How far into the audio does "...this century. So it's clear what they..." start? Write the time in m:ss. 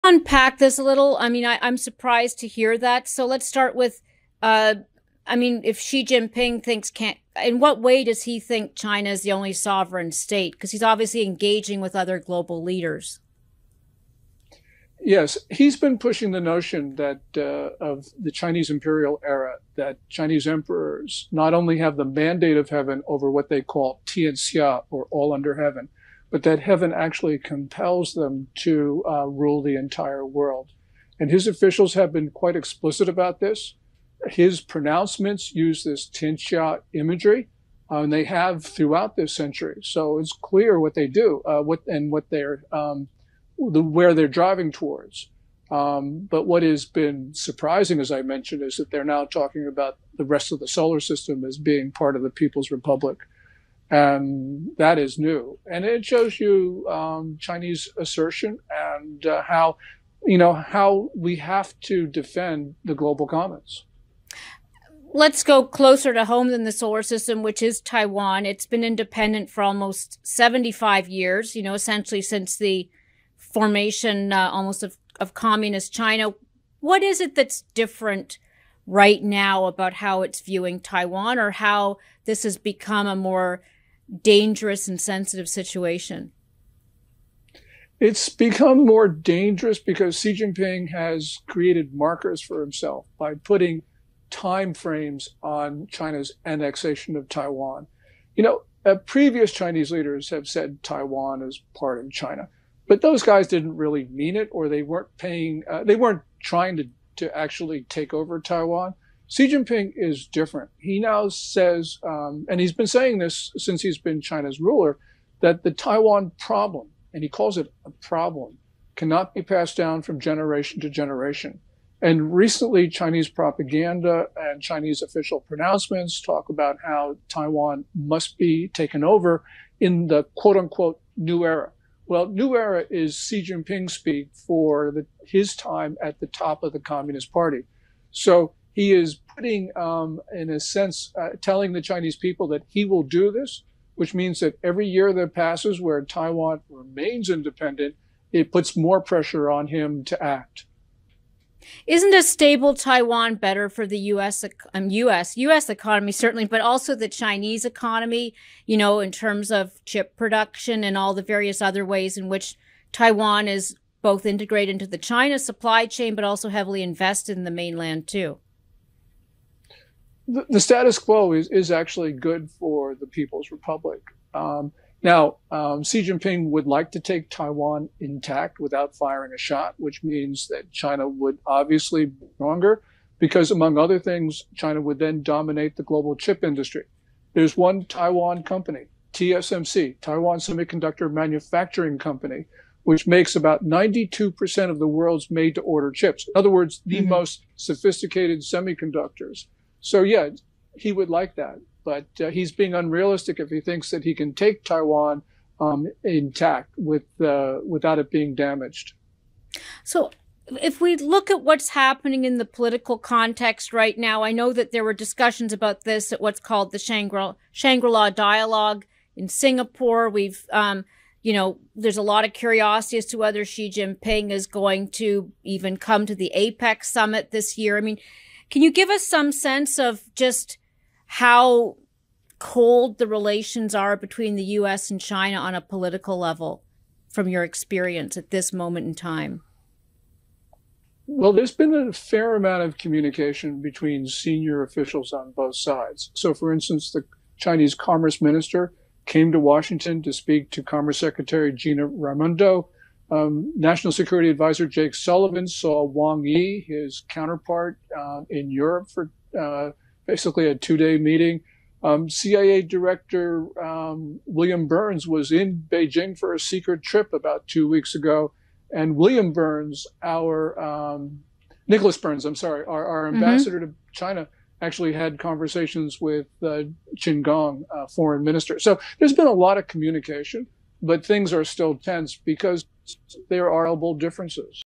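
0:39.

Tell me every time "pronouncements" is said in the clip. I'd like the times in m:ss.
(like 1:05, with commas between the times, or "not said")
0:34, 2:05.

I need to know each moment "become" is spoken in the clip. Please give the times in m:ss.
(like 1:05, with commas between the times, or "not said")
1:22, 1:28.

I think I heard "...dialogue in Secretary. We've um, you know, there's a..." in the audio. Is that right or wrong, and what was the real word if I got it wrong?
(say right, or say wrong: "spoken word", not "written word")
wrong: "Singapore", not "Secretary".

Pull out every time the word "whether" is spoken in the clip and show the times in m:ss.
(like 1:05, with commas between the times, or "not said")
3:43.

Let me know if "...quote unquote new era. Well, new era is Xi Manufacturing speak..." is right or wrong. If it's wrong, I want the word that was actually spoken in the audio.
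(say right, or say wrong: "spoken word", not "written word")
wrong: "Jinping", not "Manufacturing".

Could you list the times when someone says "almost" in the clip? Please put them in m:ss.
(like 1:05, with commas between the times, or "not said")
1:09, 1:14.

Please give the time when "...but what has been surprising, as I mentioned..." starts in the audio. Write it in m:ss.
0:46.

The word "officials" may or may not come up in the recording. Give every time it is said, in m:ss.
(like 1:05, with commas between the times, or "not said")
0:31, 2:05, 4:04.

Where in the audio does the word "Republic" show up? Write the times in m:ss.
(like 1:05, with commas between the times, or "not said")
0:52, 2:53.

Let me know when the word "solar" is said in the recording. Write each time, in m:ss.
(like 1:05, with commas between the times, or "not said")
0:50, 1:06.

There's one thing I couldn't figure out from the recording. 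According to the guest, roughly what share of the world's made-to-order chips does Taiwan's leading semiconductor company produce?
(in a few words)
92%.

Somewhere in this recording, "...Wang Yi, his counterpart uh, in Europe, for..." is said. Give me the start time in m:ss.
4:15.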